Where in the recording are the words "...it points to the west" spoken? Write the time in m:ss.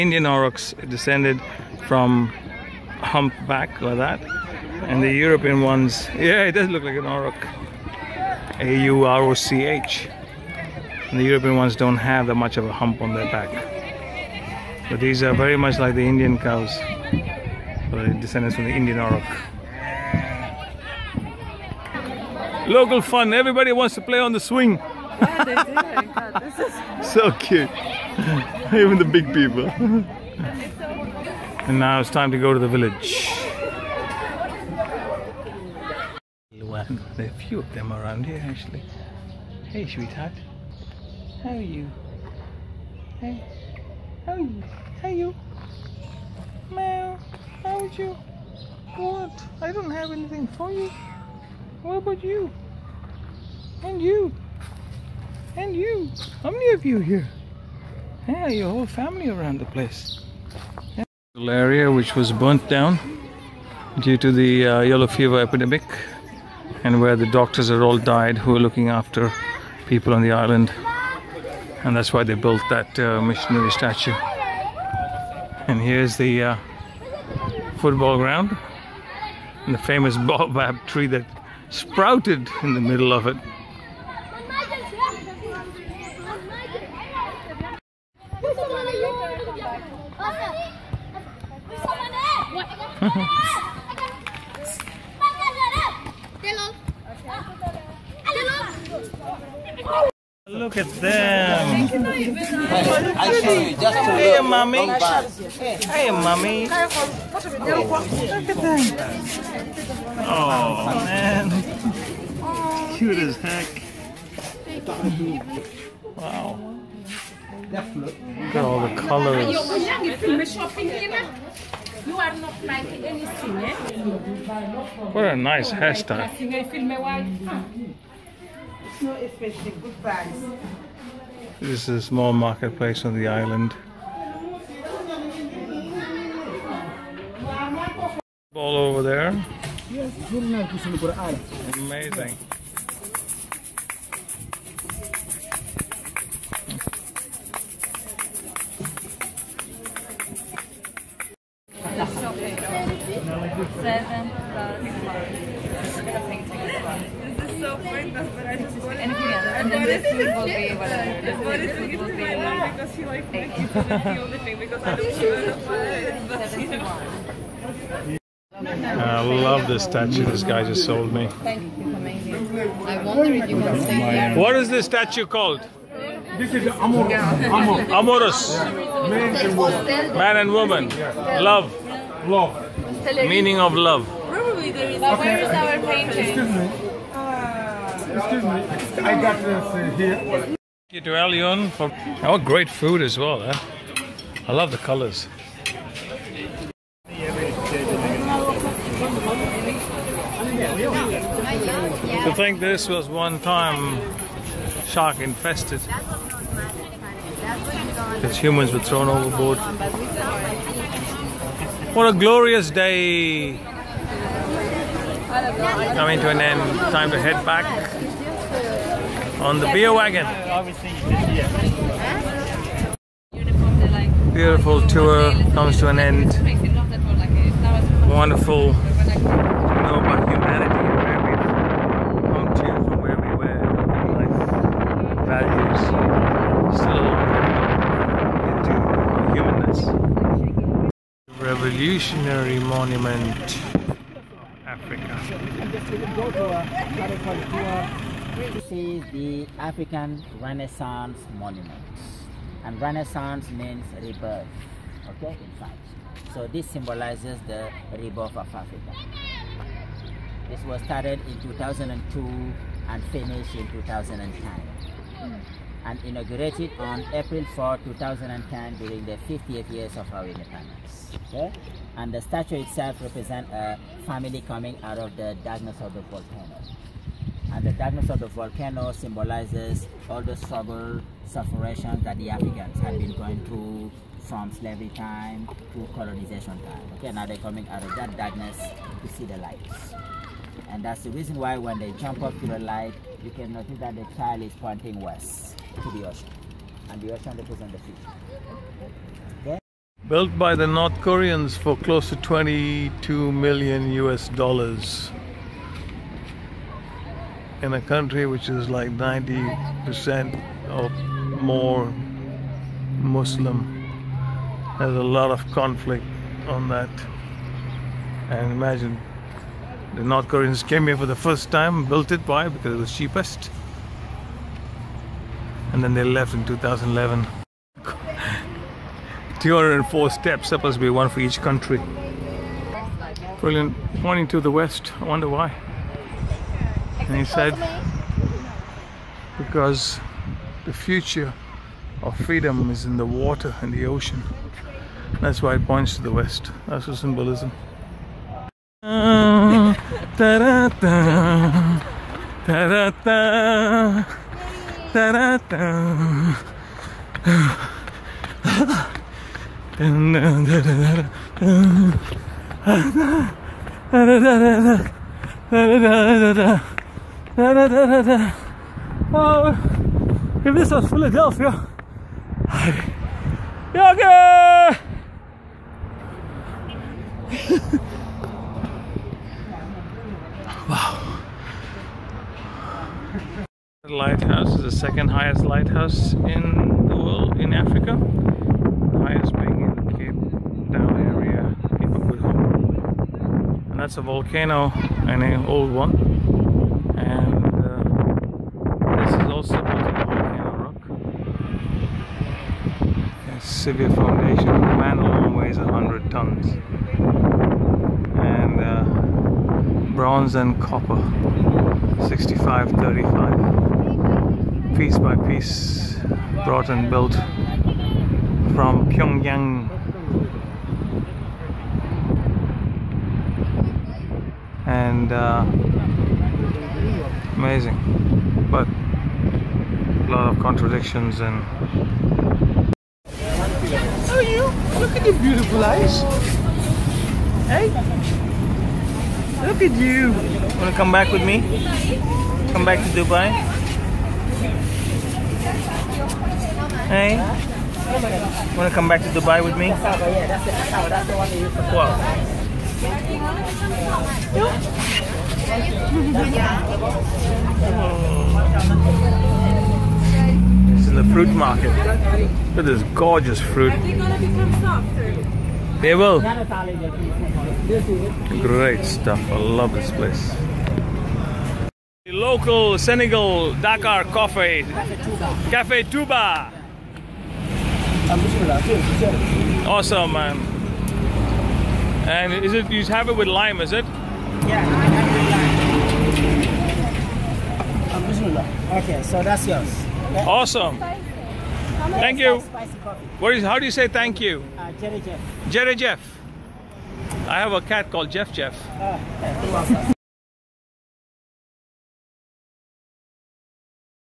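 5:45.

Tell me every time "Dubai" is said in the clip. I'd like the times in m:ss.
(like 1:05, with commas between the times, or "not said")
7:23, 7:29.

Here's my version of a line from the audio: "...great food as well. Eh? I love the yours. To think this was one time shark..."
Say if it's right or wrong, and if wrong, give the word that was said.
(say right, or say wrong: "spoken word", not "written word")
wrong: "colors", not "yours".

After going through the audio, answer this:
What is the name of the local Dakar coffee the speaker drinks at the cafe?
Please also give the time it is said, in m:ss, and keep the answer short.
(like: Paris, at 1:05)
Cafe Touba, at 7:55.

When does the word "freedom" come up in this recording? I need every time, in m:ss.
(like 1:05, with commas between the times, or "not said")
5:42.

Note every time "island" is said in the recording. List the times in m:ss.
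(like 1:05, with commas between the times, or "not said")
1:10, 2:13.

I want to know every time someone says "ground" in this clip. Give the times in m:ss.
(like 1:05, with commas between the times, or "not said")
1:18.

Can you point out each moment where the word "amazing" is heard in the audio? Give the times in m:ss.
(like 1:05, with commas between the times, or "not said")
2:21, 7:07.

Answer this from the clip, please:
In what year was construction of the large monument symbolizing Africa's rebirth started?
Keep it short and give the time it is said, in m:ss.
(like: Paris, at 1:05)
2002, at 4:21.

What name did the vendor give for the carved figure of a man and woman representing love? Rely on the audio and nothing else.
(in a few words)
Amor.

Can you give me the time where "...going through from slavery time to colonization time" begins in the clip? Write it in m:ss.
4:43.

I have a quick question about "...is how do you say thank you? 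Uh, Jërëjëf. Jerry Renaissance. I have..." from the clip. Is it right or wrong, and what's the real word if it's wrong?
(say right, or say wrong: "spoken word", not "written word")
wrong: "Jeff", not "Renaissance".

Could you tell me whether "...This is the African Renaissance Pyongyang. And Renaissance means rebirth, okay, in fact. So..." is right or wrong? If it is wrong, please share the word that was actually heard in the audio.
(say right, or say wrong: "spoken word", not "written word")
wrong: "Monument", not "Pyongyang".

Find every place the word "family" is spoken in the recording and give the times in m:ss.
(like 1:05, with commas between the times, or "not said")
0:58, 4:34.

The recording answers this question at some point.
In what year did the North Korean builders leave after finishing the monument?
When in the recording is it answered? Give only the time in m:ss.
5:26.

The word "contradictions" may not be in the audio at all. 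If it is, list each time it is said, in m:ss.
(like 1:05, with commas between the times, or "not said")
7:10.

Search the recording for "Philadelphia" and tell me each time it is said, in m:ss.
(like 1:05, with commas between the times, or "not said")
6:10.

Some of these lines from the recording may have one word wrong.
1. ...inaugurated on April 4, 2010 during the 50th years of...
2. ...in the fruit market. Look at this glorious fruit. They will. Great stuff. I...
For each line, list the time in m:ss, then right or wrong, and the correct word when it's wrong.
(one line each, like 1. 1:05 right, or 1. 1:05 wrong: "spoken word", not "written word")
1. 4:26 right
2. 7:40 wrong: "gorgeous", not "glorious".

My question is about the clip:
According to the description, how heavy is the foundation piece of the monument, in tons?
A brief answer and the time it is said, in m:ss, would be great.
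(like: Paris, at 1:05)
100 tons, at 6:45.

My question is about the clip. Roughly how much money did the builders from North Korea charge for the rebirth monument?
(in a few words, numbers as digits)
22 million US dollars.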